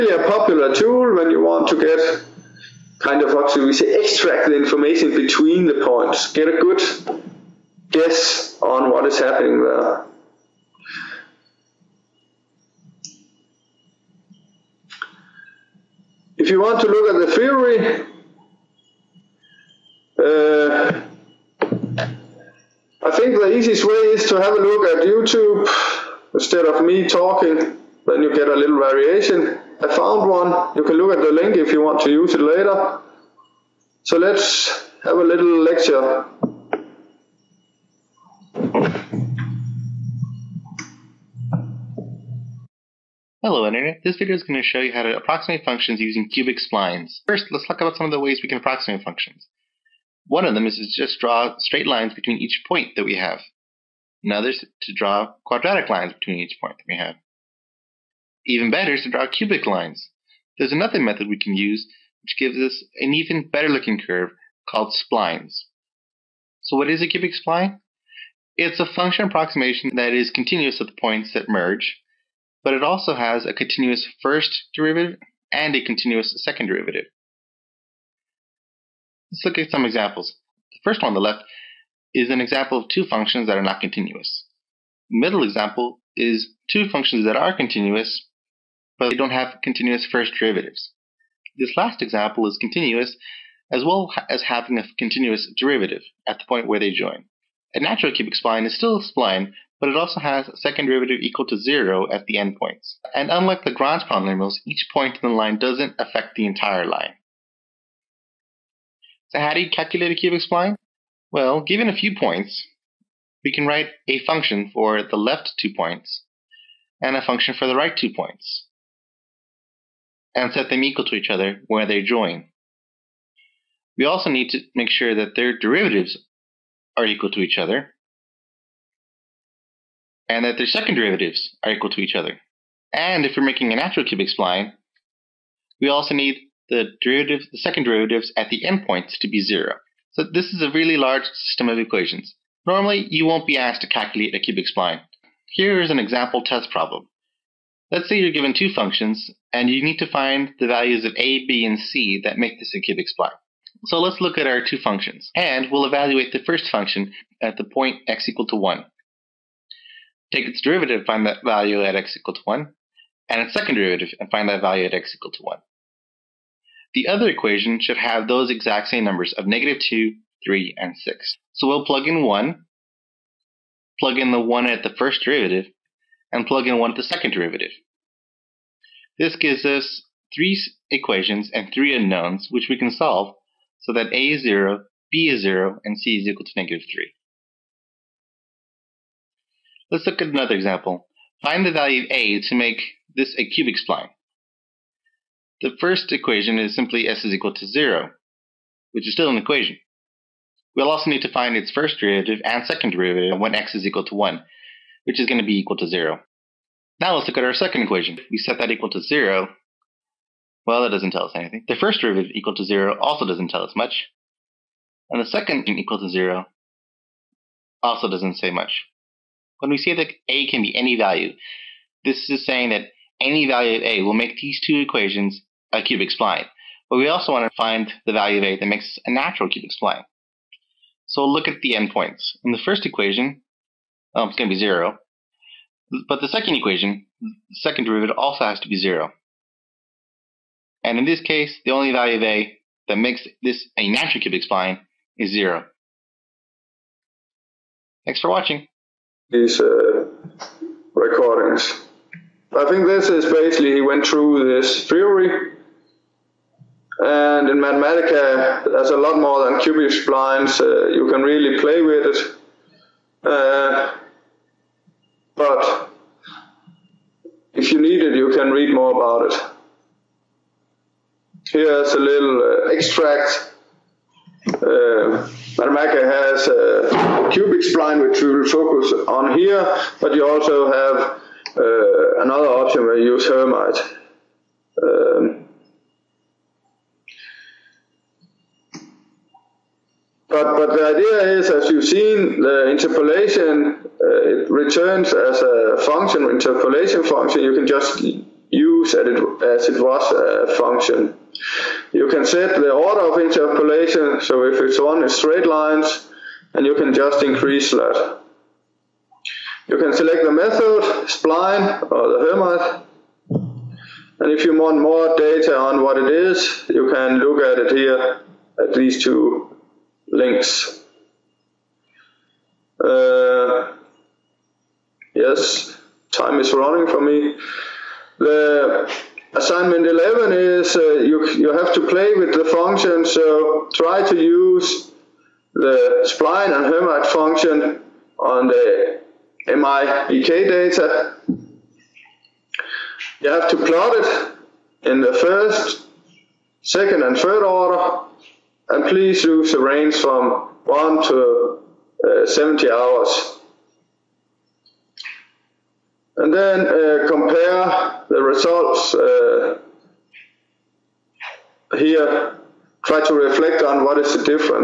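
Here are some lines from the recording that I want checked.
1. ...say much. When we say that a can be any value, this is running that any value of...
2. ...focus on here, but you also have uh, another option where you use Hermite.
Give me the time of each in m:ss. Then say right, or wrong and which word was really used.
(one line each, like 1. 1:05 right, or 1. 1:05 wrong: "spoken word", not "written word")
1. 3:38 wrong: "saying", not "running"
2. 4:38 right.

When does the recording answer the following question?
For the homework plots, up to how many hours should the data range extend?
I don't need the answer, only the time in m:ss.
5:52.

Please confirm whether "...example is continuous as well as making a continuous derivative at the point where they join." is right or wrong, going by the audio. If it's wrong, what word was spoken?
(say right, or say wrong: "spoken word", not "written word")
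wrong: "having", not "making".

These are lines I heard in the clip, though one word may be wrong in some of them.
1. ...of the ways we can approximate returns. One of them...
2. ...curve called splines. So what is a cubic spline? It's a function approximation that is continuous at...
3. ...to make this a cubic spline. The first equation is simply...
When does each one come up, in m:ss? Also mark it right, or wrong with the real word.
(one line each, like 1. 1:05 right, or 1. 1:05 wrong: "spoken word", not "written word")
1. 0:48 wrong: "functions", not "returns"
2. 1:04 right
3. 3:12 right.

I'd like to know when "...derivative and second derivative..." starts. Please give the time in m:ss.
3:21.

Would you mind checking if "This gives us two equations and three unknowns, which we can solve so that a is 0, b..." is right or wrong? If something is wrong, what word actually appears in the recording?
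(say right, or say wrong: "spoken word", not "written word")
wrong: "three", not "two".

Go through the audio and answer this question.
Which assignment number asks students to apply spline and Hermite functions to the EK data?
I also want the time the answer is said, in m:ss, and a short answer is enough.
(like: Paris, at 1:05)
11, at 5:29.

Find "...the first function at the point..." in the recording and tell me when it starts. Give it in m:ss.
2:36.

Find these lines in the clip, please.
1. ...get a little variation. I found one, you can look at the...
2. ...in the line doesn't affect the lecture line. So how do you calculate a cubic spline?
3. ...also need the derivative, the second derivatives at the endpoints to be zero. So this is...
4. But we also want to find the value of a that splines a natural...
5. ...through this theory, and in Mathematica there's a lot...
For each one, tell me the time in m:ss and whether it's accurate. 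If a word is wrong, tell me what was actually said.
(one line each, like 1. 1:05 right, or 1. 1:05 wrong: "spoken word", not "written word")
1. 0:28 right
2. 1:45 wrong: "entire", not "lecture"
3. 2:15 right
4. 3:46 wrong: "makes", not "splines"
5. 4:14 right.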